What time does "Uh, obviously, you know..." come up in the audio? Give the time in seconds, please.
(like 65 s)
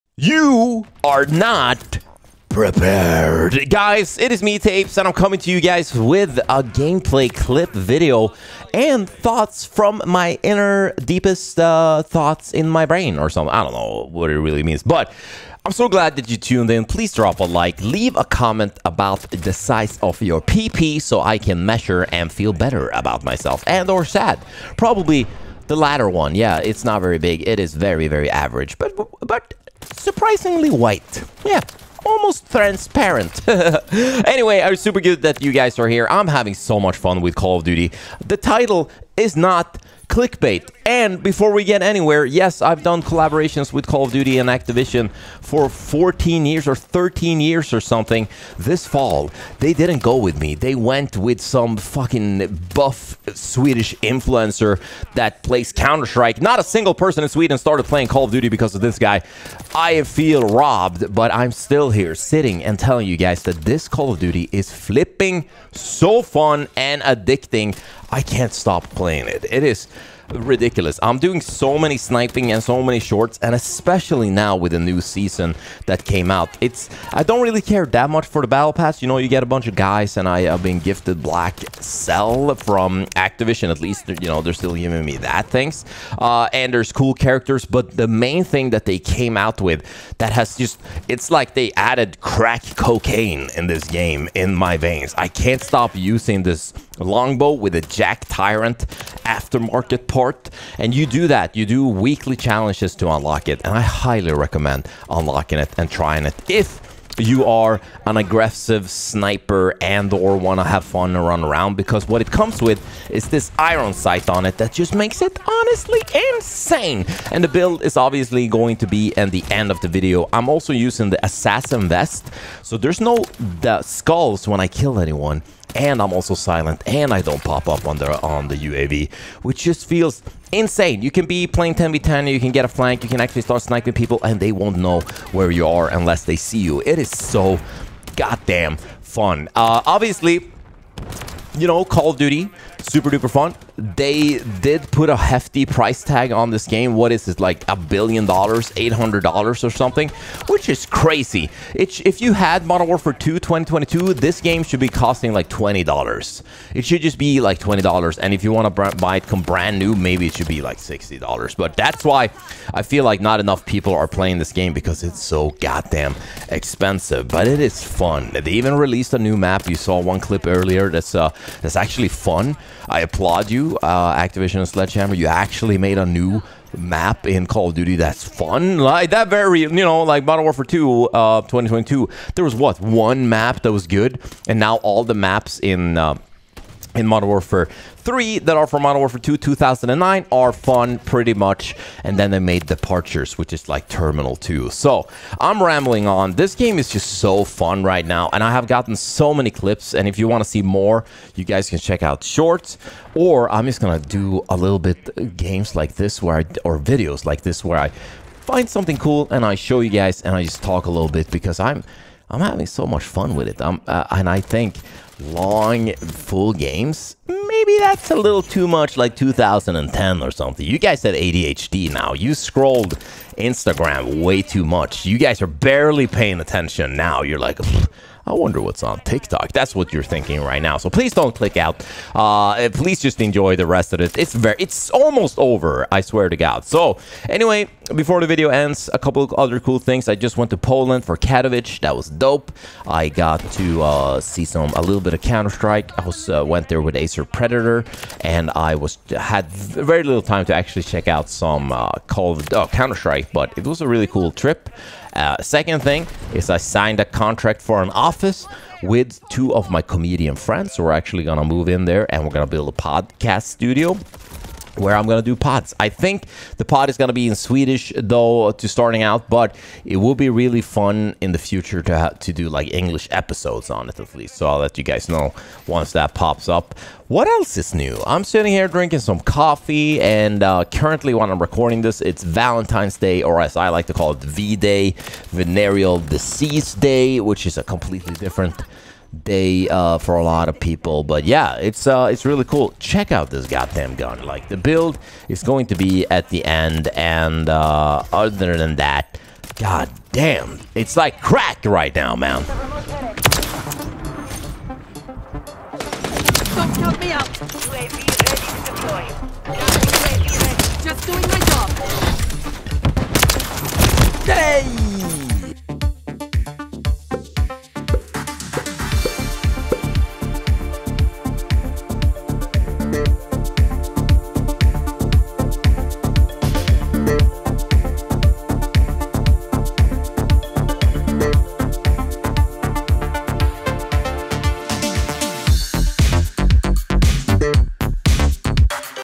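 139 s.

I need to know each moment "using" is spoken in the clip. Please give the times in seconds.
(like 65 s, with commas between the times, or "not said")
95 s, 120 s.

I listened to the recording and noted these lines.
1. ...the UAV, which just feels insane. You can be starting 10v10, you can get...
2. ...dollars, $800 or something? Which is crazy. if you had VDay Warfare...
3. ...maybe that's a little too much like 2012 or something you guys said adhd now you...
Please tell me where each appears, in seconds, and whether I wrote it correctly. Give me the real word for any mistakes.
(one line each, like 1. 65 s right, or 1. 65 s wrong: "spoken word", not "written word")
1. 128 s wrong: "playing", not "starting"
2. 148 s wrong: "Modern", not "VDay"
3. 217 s wrong: "2010", not "2012".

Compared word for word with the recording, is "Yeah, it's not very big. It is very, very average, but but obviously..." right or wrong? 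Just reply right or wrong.
wrong.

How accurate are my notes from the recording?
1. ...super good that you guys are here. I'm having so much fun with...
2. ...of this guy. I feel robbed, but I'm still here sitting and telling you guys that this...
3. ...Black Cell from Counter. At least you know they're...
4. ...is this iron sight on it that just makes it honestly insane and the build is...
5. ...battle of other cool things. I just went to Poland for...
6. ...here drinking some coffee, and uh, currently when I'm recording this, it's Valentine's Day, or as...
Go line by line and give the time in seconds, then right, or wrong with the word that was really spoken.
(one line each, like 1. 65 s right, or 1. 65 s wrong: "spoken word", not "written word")
1. 34 s right
2. 58 s right
3. 81 s wrong: "Activision", not "Counter"
4. 113 s right
5. 238 s wrong: "couple", not "battle"
6. 278 s right.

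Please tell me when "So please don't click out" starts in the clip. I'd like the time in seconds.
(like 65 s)
230 s.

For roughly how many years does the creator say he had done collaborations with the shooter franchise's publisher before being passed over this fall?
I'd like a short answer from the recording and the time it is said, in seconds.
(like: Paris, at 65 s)
14 years, at 45 s.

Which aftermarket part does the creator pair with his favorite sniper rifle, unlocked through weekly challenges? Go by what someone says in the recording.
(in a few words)
JAK Tyrant.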